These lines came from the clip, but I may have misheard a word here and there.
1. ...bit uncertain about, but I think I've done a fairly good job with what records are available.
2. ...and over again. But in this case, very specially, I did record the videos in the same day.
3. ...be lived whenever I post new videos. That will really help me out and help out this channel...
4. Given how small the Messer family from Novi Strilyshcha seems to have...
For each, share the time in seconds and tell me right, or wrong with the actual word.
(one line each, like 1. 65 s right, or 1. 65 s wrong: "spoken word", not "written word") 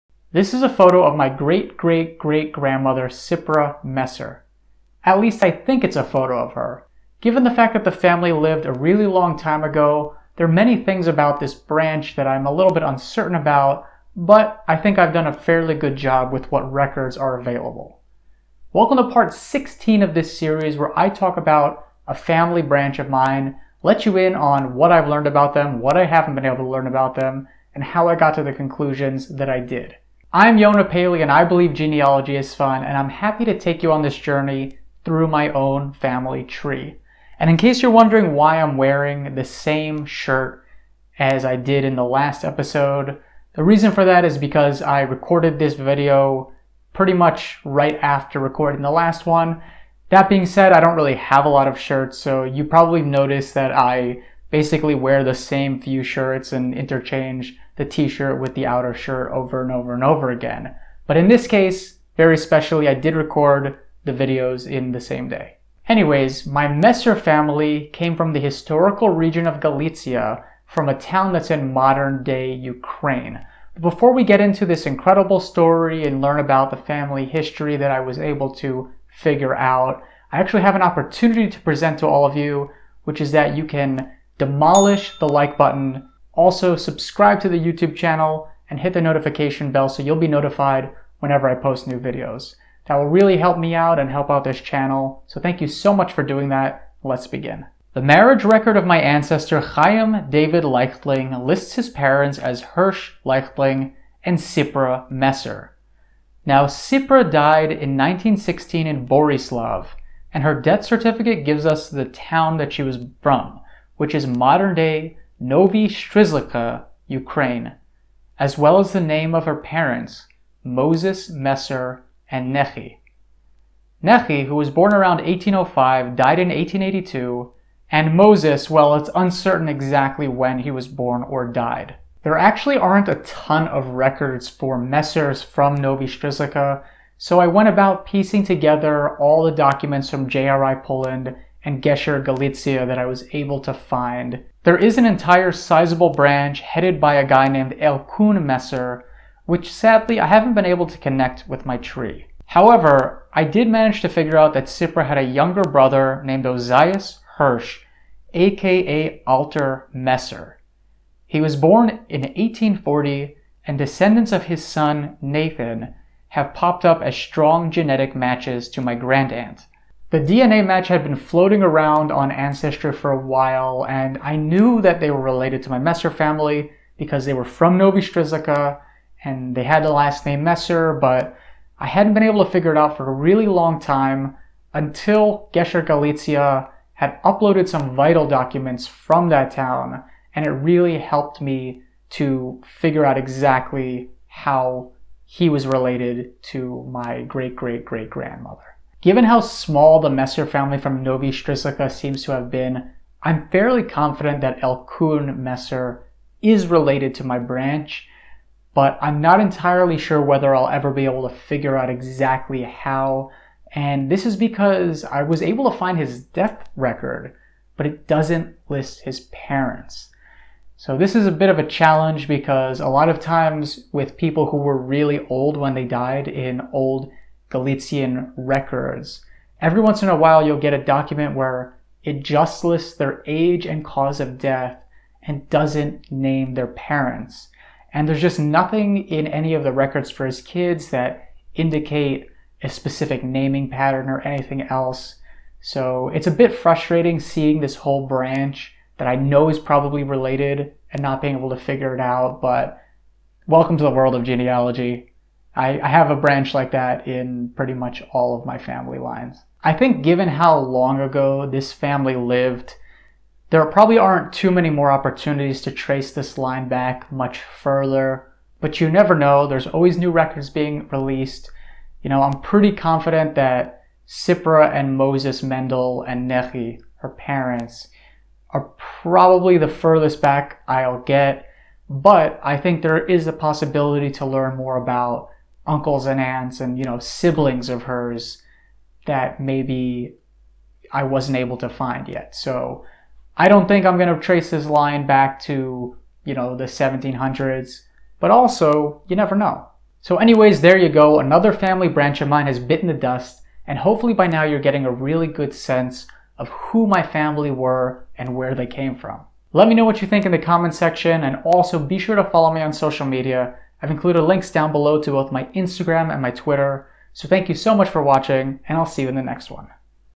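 1. 12 s right
2. 59 s right
3. 90 s wrong: "notified", not "lived"
4. 199 s right.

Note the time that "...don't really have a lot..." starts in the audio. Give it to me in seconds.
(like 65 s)
50 s.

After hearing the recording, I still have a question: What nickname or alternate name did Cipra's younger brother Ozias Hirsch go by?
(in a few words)
Alter Messer.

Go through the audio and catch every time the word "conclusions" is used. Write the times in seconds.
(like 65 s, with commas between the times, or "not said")
28 s.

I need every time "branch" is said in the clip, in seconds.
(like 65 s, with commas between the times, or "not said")
11 s, 22 s, 146 s, 207 s, 248 s, 256 s, 301 s.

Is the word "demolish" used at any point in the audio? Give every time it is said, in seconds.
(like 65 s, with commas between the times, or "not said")
84 s.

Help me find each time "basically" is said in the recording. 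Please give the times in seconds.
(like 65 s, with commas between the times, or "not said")
54 s.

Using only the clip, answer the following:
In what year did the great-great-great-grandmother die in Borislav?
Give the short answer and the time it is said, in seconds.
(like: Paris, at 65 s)
1916, at 107 s.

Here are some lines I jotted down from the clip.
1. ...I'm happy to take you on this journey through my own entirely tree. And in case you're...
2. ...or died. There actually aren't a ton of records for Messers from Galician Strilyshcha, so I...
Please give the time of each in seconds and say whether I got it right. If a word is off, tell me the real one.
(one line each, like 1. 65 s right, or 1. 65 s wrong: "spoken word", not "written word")
1. 32 s wrong: "family", not "entirely"
2. 131 s wrong: "Novi", not "Galician".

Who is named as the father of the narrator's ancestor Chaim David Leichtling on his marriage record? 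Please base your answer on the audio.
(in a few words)
Hirsch Leichtling.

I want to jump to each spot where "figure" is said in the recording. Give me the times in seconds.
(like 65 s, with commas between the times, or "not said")
79 s, 154 s, 182 s, 192 s, 211 s, 251 s.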